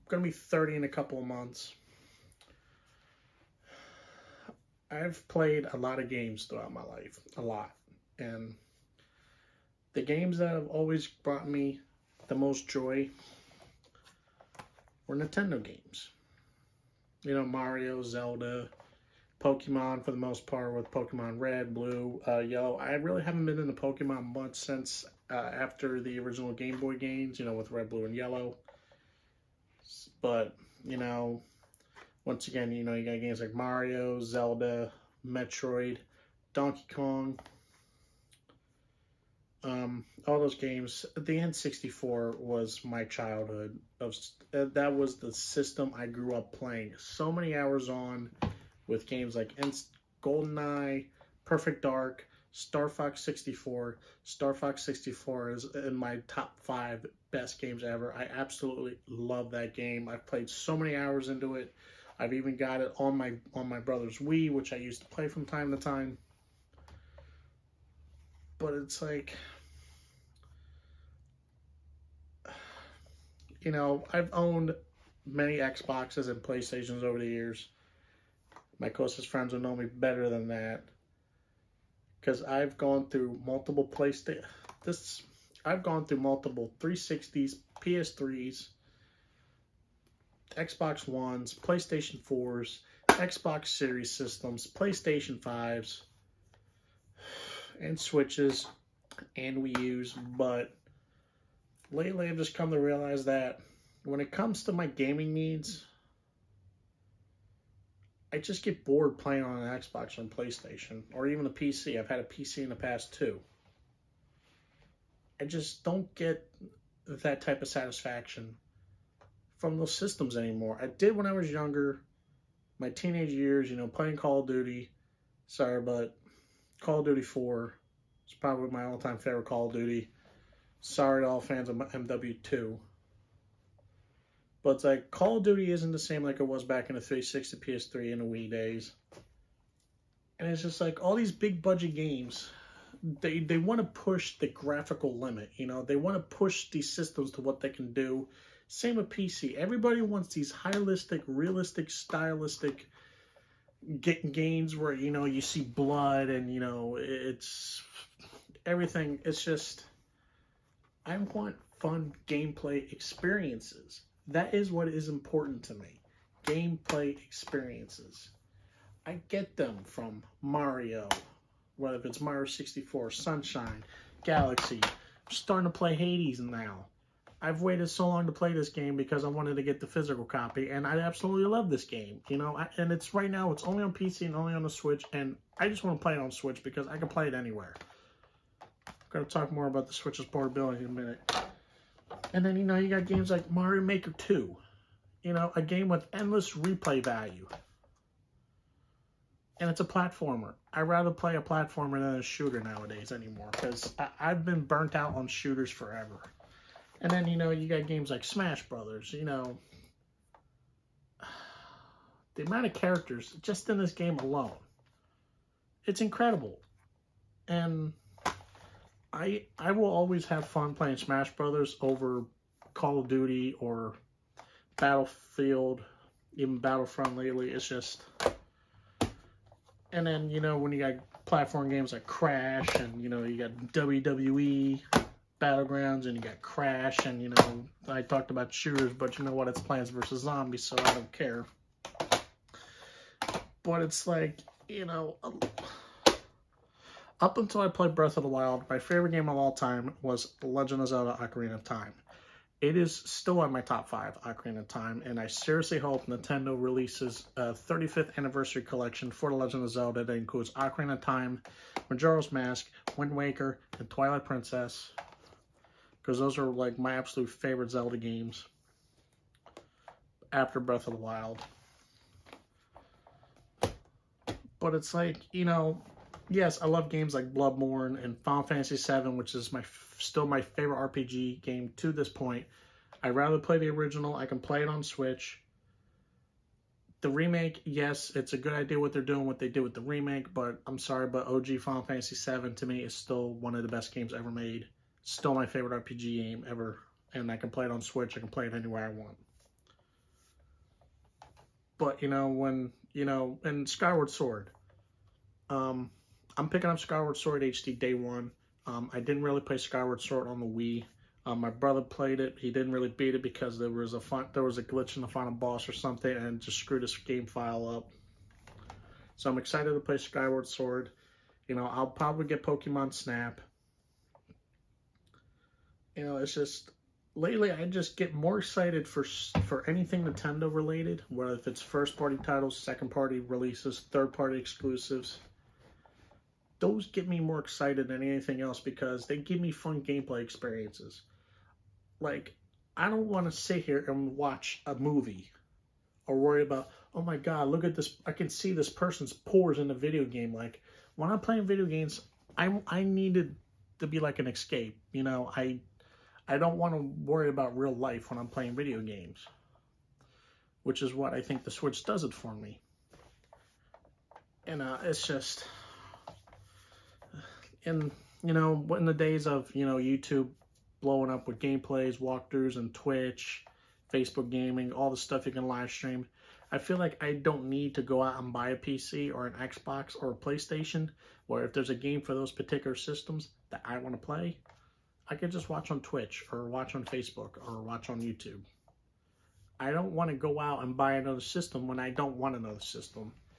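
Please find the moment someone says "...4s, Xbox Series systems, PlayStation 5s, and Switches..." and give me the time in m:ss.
1:32.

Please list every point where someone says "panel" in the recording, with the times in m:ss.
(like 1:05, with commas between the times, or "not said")
not said.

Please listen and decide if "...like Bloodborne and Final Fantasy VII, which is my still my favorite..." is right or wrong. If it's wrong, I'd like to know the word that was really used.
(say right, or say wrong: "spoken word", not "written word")
right.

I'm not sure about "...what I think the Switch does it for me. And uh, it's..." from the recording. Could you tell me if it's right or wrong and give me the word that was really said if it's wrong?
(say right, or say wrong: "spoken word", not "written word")
right.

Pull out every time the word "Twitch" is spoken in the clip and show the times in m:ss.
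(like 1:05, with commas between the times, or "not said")
6:12, 6:25.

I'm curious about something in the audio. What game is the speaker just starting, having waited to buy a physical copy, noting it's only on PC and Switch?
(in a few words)
Hades.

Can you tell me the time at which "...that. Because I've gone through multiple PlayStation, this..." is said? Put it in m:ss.
1:20.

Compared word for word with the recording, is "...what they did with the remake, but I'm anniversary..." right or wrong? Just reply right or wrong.
wrong.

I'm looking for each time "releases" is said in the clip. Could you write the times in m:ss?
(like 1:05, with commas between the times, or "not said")
4:16, 5:33.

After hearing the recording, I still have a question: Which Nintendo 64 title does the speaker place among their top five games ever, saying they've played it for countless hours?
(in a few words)
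Star Fox 64.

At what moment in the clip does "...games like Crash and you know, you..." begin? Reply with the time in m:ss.
3:51.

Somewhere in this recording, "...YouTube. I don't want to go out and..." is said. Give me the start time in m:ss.
6:28.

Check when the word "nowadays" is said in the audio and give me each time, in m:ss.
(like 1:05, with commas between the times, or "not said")
3:22.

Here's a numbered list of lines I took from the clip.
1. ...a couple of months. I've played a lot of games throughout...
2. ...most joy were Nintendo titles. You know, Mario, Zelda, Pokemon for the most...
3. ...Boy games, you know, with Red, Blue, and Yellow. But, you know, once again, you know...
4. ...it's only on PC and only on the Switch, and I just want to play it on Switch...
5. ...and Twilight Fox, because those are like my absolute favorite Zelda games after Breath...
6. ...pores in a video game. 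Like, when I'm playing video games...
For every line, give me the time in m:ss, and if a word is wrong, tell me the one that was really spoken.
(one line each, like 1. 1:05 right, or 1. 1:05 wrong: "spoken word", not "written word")
1. 0:00 right
2. 0:12 wrong: "games", not "titles"
3. 0:26 right
4. 3:03 right
5. 4:23 wrong: "Princess", not "Fox"
6. 5:49 right.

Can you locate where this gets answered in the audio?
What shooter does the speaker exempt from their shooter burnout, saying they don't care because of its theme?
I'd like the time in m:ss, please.
3:59.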